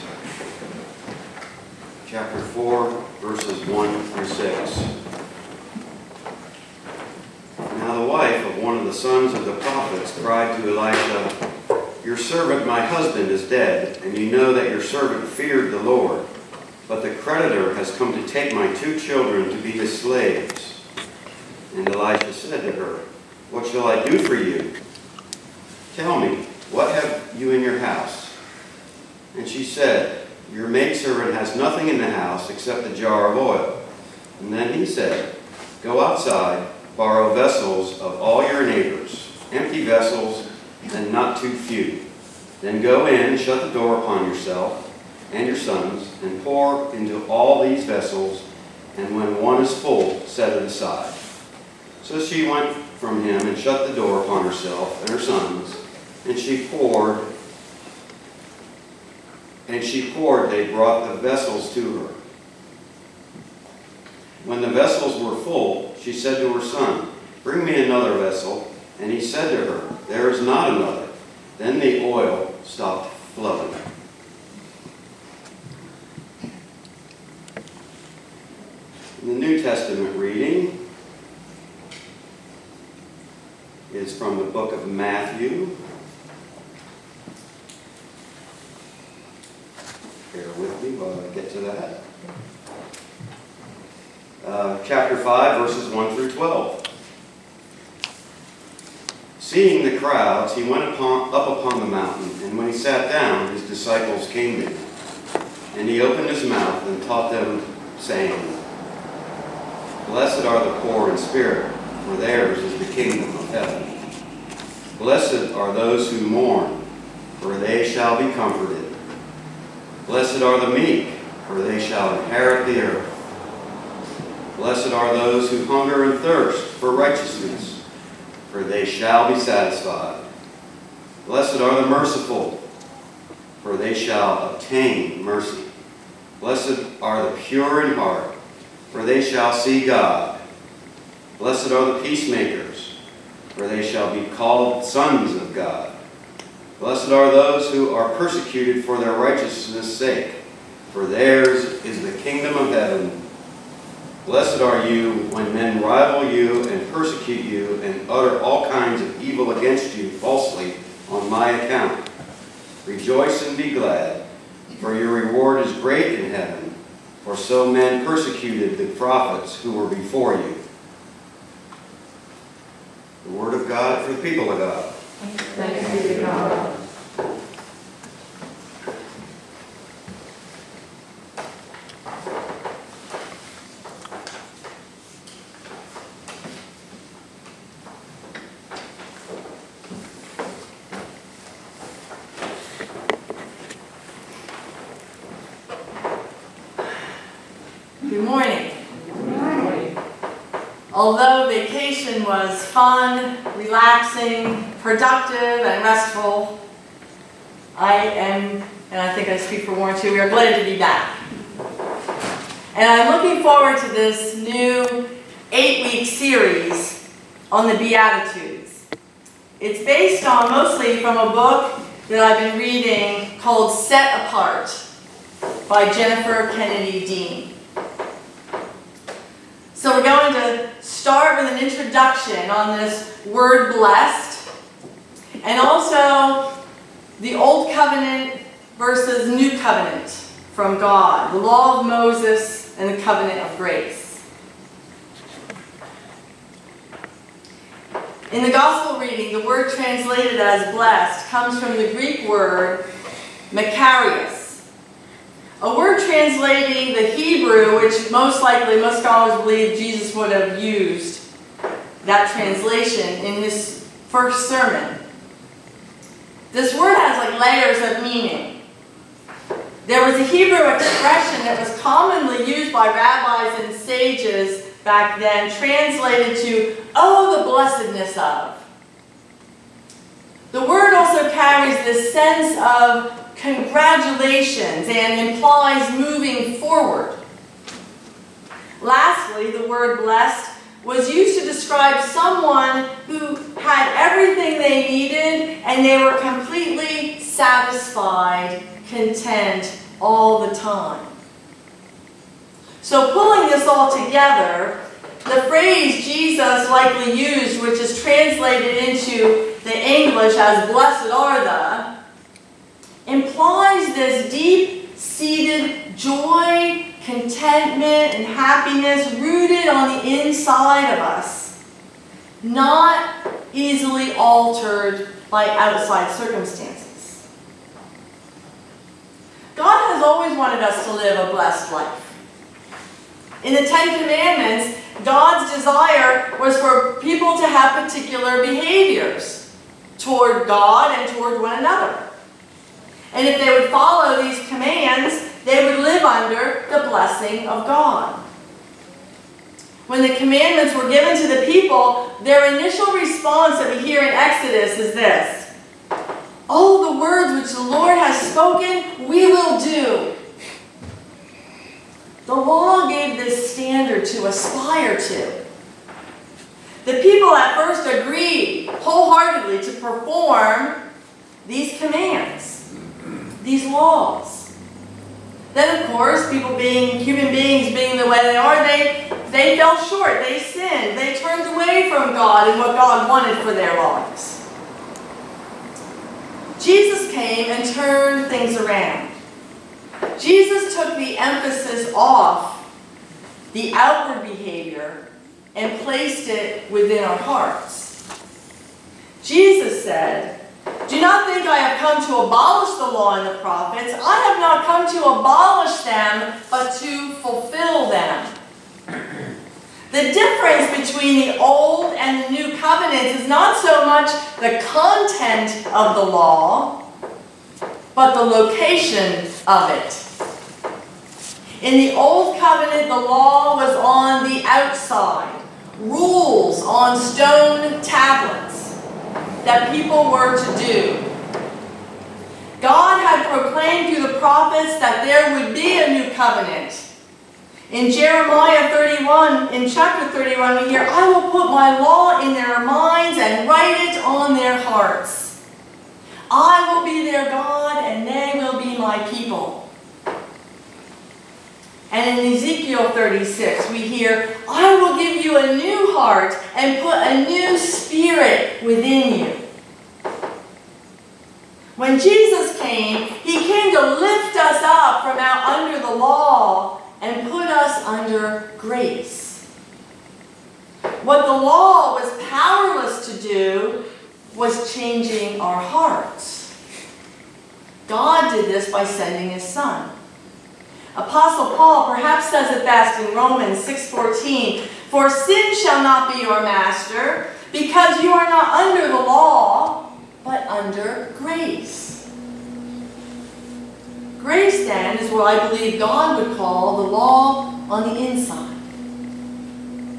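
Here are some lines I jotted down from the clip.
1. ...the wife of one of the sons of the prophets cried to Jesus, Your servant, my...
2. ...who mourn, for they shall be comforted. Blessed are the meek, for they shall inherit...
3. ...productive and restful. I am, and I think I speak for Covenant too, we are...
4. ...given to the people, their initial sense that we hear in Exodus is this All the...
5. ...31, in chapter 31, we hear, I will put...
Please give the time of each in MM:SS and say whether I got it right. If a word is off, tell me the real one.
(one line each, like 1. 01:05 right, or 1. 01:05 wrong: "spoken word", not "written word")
1. 00:07 wrong: "Elisha", not "Jesus"
2. 01:56 right
3. 03:24 wrong: "Warren", not "Covenant"
4. 05:50 wrong: "response", not "sense"
5. 07:18 right.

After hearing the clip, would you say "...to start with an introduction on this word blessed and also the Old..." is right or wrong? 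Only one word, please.
right.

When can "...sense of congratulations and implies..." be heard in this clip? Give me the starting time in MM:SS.
04:42.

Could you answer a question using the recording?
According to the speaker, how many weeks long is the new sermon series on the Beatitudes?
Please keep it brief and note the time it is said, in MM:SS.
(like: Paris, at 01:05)
8, at 03:35.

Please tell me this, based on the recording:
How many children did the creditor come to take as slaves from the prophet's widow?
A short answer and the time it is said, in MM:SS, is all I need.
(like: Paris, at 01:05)
2, at 00:18.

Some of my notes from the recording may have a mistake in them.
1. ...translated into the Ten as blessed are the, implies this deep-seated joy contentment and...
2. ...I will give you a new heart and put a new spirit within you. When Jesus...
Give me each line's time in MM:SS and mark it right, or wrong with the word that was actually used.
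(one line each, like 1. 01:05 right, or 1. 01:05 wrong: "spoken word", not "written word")
1. 05:08 wrong: "English", not "Ten"
2. 07:34 right.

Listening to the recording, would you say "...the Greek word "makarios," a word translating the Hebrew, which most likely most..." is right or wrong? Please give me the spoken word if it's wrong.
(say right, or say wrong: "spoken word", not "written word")
right.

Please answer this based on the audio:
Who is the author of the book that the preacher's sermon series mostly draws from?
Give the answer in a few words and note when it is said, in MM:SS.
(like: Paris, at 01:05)
Jennifer Kennedy Dean, at 03:45.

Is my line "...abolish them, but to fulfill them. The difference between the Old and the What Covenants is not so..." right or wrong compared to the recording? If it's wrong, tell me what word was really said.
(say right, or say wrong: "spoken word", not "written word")
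wrong: "New", not "What".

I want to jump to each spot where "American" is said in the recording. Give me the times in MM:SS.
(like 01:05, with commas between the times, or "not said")
not said.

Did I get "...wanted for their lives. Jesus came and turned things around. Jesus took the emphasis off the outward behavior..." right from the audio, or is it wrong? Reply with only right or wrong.
right.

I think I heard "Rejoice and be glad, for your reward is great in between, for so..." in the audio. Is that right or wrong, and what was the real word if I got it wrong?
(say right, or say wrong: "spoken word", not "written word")
wrong: "heaven", not "between".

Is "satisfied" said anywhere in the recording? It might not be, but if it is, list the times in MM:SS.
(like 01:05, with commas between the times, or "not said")
02:09, 04:57.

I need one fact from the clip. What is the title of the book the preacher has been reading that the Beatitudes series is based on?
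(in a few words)
Set Apart.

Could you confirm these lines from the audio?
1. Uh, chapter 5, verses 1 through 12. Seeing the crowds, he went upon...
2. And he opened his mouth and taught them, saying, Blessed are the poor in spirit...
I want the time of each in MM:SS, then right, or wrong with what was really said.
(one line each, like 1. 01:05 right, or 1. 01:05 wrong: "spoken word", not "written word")
1. 01:34 right
2. 01:45 right.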